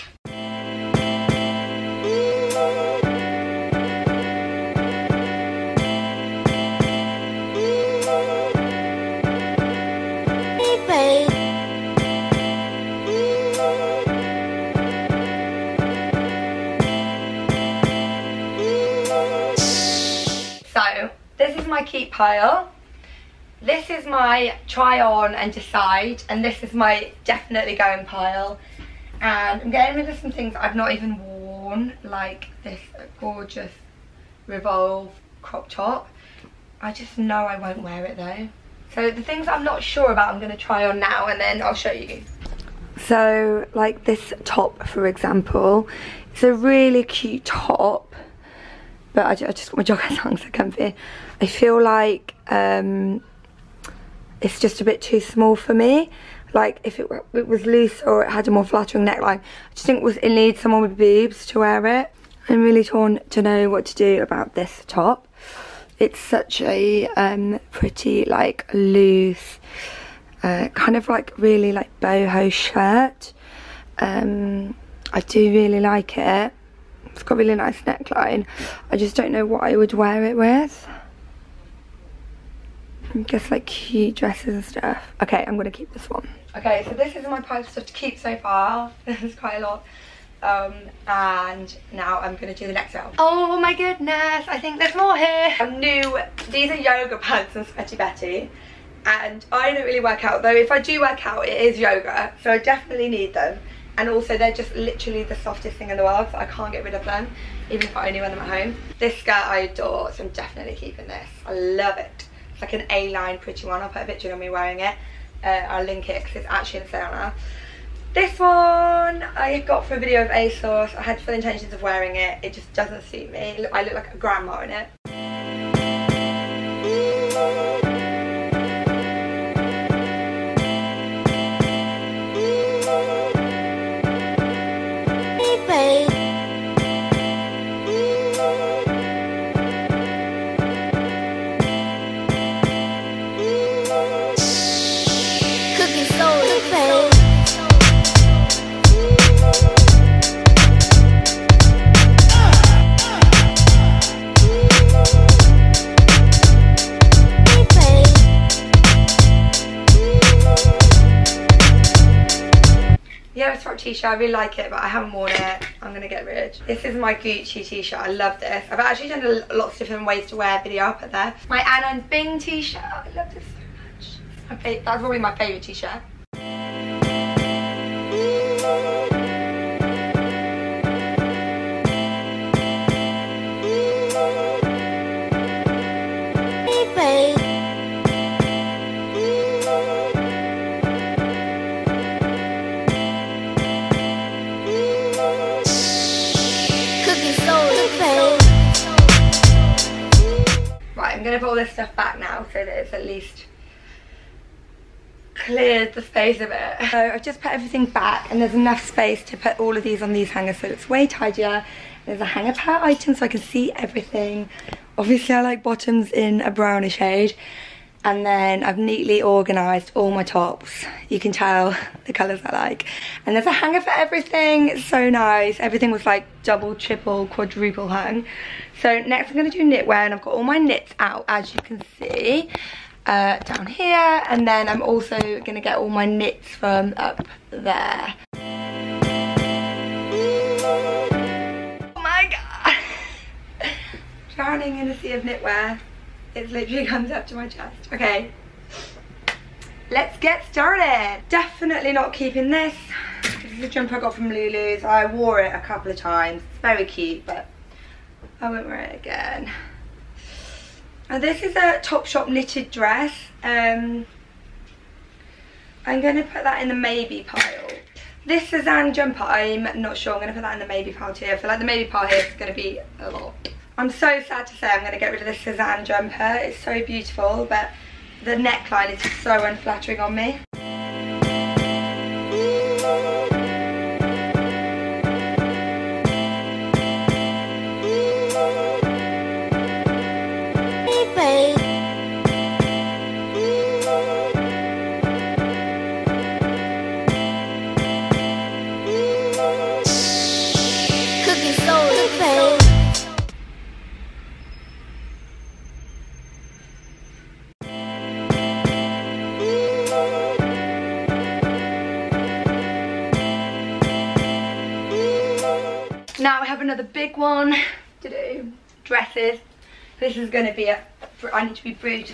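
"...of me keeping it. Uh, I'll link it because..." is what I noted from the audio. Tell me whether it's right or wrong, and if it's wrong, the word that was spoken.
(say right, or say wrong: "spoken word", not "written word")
wrong: "wearing", not "keeping".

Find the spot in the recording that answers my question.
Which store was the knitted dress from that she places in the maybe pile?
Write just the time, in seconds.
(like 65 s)
261 s.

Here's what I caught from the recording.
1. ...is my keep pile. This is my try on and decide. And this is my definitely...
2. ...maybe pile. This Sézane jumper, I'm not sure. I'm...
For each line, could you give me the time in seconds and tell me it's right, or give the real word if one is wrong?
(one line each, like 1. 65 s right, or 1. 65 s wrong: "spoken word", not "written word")
1. 21 s right
2. 266 s right.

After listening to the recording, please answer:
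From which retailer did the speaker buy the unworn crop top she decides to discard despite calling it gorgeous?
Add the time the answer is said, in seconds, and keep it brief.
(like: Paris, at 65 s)
Revolve, at 34 s.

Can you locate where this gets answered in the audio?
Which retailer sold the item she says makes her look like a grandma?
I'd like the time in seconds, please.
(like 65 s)
120 s.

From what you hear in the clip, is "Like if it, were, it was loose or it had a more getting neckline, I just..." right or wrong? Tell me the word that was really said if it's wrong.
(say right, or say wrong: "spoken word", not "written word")
wrong: "flattering", not "getting".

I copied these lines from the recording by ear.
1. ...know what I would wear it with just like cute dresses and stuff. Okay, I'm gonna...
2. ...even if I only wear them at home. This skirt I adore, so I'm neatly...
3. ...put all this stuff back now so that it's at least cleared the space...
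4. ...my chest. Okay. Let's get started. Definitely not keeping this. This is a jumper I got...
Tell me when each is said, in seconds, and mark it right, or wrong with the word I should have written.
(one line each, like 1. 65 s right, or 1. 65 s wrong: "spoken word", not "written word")
1. 79 s right
2. 107 s wrong: "definitely", not "neatly"
3. 201 s right
4. 247 s right.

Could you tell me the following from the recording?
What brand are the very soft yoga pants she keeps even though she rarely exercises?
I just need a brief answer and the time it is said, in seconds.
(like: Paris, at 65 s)
Sweaty Betty, at 97 s.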